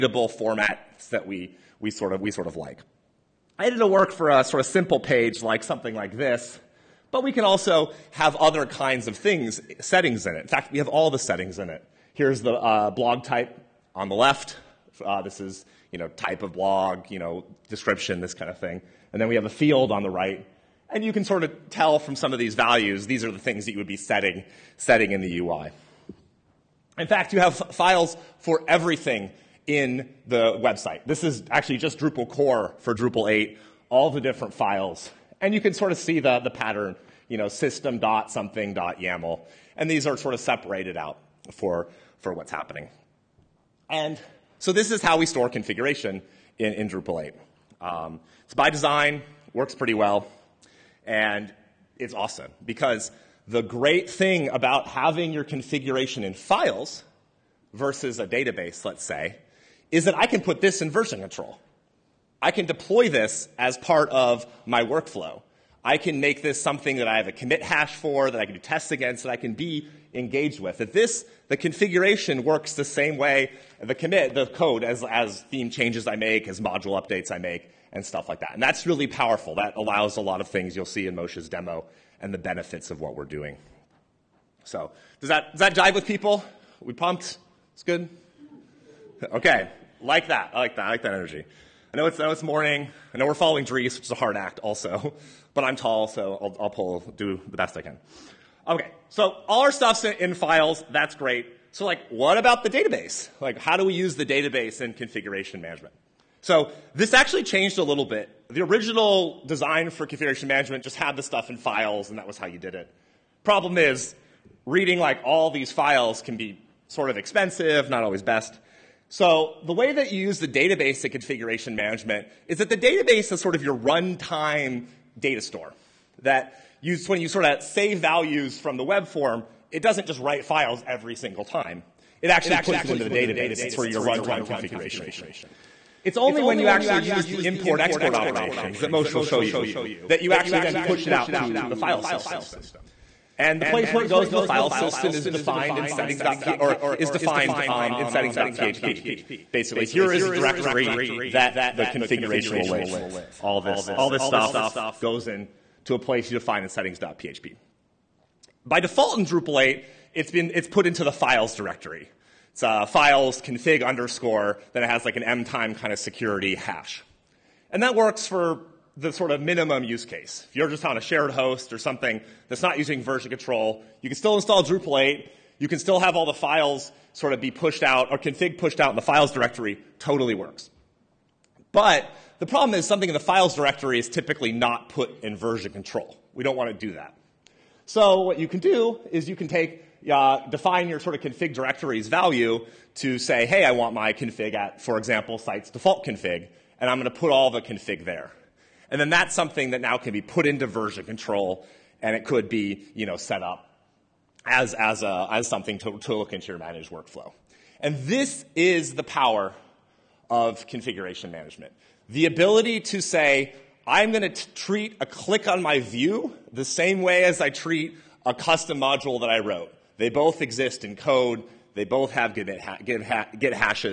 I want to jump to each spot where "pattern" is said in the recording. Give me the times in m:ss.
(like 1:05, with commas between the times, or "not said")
0:36.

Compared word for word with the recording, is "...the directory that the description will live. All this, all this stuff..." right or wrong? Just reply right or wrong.
wrong.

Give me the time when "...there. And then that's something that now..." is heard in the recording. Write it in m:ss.
3:18.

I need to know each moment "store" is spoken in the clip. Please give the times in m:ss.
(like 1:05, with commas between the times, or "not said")
0:45, 2:05.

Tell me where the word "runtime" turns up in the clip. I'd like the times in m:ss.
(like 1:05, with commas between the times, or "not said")
2:03, 2:14.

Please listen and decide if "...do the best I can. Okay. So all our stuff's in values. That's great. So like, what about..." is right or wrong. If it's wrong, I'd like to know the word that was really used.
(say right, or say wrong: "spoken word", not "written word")
wrong: "files", not "values".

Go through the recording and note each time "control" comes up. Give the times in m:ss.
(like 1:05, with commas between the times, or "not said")
1:01, 2:53, 3:05, 3:21.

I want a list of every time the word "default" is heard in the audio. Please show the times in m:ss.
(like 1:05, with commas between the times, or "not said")
2:38, 3:15.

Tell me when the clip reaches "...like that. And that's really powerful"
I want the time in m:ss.
1:18.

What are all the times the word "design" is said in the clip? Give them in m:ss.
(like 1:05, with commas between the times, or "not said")
0:48, 1:49.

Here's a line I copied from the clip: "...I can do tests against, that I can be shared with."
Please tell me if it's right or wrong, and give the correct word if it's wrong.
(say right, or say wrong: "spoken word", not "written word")
wrong: "engaged", not "shared".